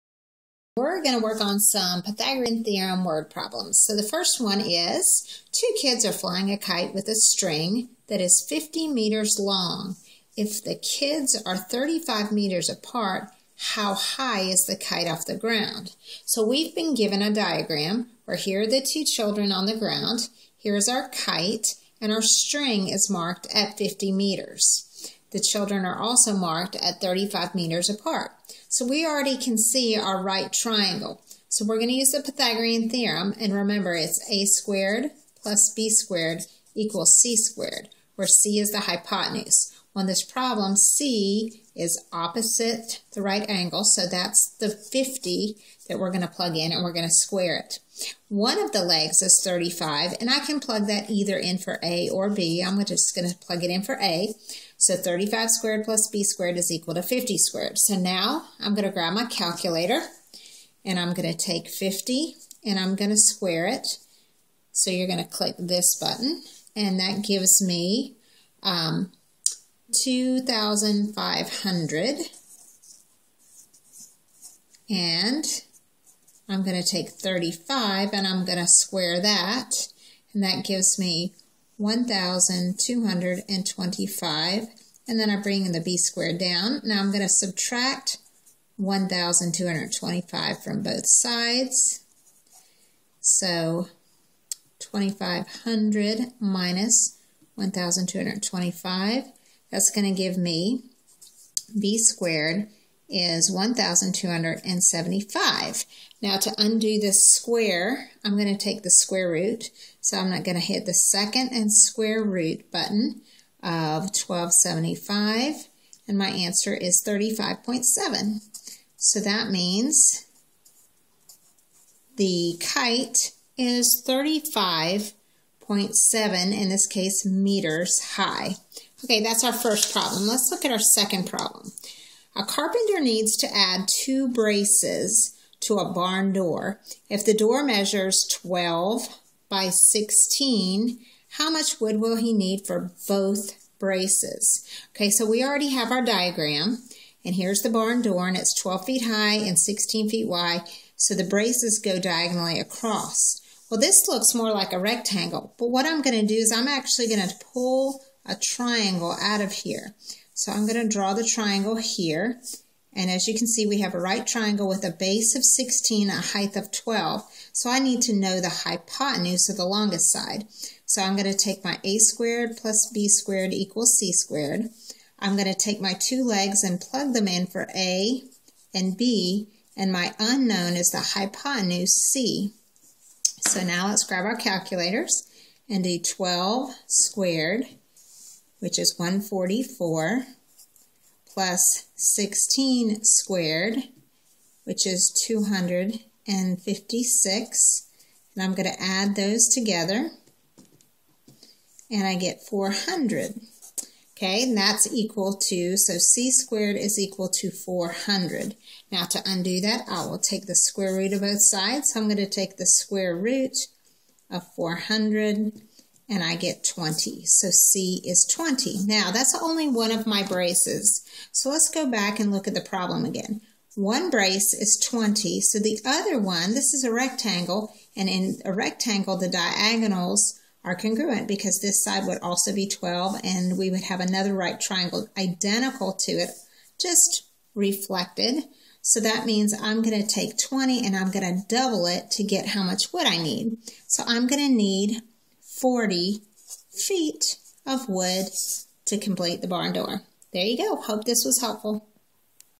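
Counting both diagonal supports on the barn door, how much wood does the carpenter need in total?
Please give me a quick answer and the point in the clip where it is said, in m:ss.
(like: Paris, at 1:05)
40 feet, at 4:05.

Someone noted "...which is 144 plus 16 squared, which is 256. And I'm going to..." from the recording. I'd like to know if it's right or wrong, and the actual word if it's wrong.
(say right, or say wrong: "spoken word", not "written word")
right.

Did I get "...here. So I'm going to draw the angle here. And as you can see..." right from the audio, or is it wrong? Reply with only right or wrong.
wrong.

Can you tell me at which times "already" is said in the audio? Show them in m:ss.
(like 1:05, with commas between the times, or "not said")
0:29, 2:25.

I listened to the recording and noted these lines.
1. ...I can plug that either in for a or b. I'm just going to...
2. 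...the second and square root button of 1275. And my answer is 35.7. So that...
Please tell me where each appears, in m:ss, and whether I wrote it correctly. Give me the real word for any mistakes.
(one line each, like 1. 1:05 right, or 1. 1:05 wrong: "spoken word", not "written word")
1. 0:50 right
2. 1:50 right.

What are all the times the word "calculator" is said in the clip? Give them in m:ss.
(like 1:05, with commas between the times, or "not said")
0:59, 3:04.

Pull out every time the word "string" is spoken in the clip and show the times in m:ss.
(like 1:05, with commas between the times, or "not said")
0:07, 0:22.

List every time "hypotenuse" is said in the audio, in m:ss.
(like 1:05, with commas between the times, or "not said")
0:38, 2:48, 3:01.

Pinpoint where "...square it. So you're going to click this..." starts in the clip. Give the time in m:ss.
1:03.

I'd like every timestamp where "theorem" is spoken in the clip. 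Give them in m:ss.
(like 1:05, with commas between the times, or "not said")
0:02, 0:32.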